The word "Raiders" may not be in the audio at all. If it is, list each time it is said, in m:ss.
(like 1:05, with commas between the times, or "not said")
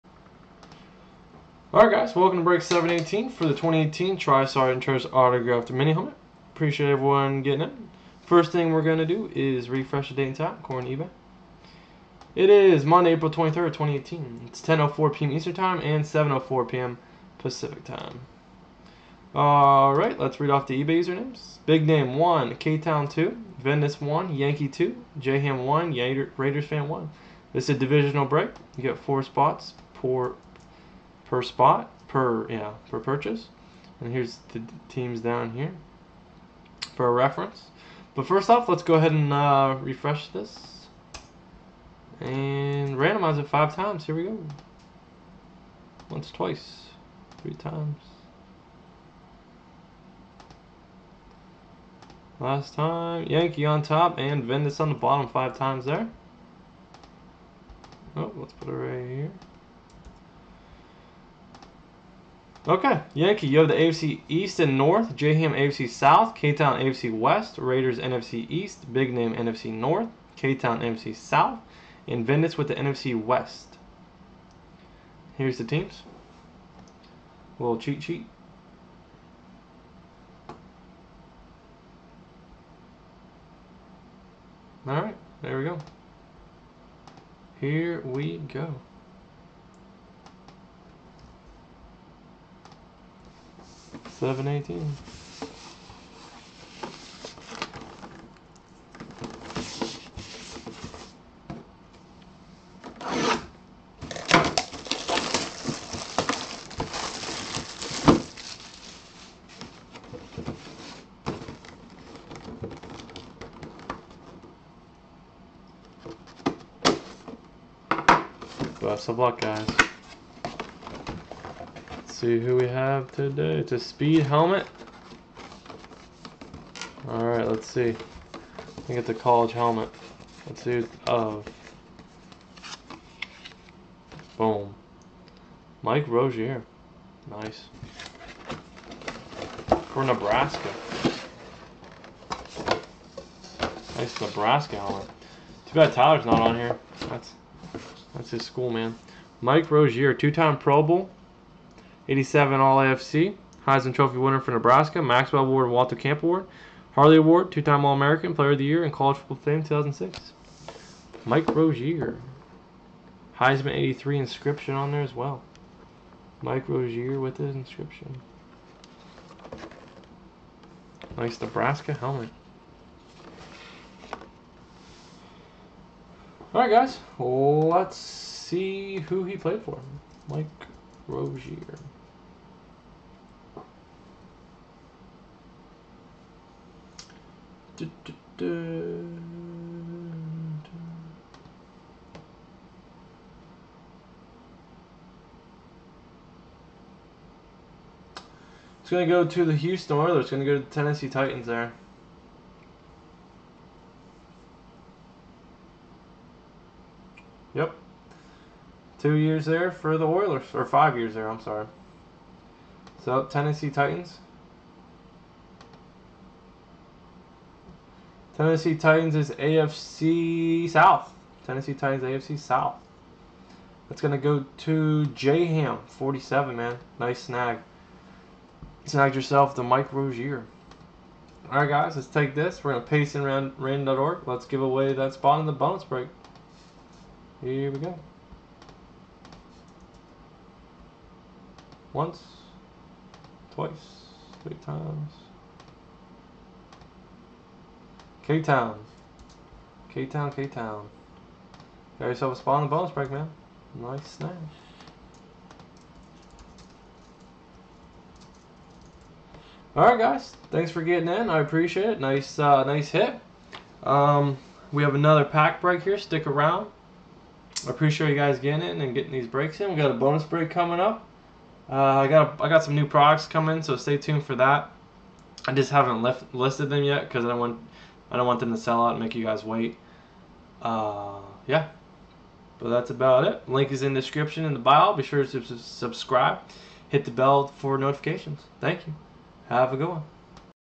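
0:26, 1:07.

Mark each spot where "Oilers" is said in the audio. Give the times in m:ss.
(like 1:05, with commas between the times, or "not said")
3:19, 3:30.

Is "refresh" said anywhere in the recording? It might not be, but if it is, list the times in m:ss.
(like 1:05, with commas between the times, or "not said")
0:09, 0:39.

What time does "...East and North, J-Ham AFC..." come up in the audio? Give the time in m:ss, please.
1:04.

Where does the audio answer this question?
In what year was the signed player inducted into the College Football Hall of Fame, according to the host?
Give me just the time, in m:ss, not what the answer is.
2:38.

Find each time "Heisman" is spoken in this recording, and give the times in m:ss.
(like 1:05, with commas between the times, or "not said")
2:33, 2:43.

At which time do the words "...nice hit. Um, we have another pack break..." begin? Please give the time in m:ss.
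4:22.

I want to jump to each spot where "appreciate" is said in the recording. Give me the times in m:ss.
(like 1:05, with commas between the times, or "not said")
0:06, 4:21, 4:27.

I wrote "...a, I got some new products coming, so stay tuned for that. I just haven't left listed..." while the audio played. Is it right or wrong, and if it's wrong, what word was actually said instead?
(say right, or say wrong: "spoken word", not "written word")
right.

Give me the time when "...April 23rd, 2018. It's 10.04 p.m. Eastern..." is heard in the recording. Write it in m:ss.
0:13.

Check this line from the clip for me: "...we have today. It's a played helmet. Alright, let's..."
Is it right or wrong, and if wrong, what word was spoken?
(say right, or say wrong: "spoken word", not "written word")
wrong: "speed", not "played".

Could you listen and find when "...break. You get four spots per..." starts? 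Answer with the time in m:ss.
0:28.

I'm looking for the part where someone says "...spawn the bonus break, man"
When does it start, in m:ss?
4:12.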